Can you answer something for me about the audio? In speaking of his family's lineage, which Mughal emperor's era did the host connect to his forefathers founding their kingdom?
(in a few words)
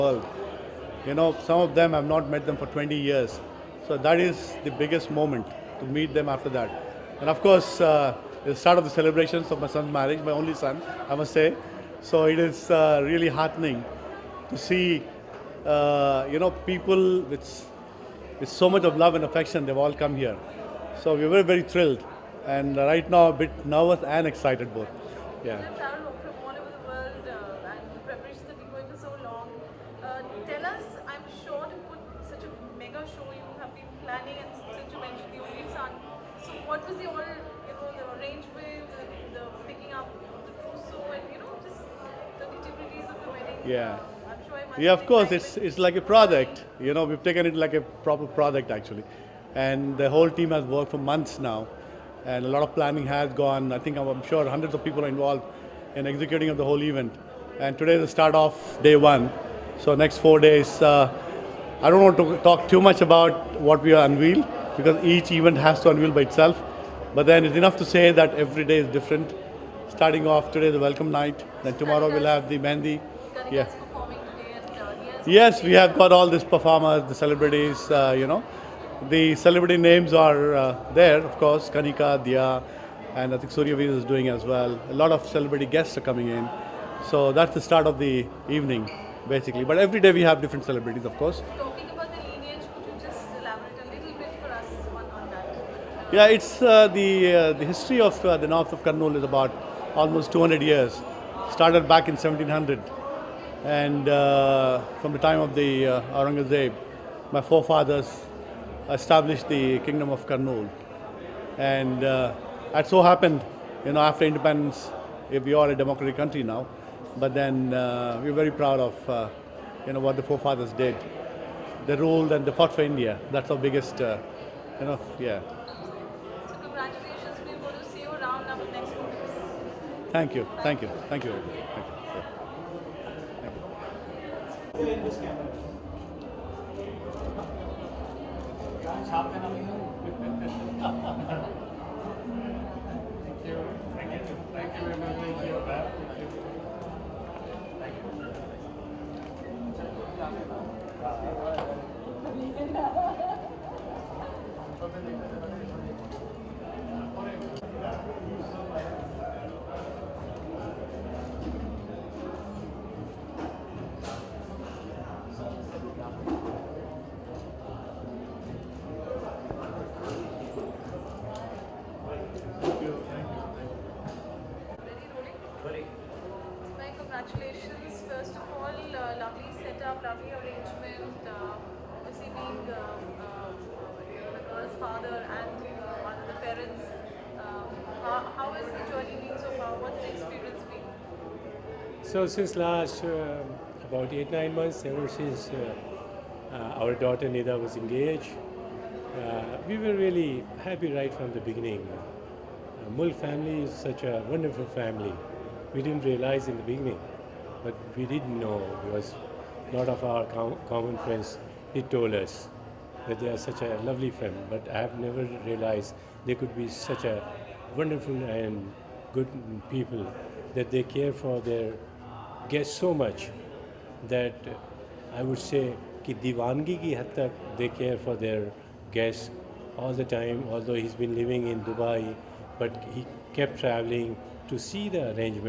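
Aurangzeb.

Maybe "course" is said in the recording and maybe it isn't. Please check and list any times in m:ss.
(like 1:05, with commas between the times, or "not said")
0:07, 0:45, 1:21, 1:31.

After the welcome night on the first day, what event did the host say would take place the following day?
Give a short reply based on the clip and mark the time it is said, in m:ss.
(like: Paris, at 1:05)
mandi, at 1:12.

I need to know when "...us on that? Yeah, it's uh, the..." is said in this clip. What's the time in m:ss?
1:34.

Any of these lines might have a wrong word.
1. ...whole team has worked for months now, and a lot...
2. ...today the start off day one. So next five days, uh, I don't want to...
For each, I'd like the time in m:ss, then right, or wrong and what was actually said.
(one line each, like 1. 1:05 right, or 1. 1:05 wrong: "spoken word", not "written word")
1. 0:50 right
2. 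0:57 wrong: "four", not "five".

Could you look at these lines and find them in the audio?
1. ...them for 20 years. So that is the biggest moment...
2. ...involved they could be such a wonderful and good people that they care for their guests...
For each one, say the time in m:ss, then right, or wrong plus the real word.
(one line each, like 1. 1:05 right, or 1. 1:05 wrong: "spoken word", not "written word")
1. 0:02 right
2. 3:35 wrong: "realized", not "involved".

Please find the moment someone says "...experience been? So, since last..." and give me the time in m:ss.
3:10.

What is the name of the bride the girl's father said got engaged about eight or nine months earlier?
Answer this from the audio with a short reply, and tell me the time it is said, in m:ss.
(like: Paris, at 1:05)
Nida, at 3:17.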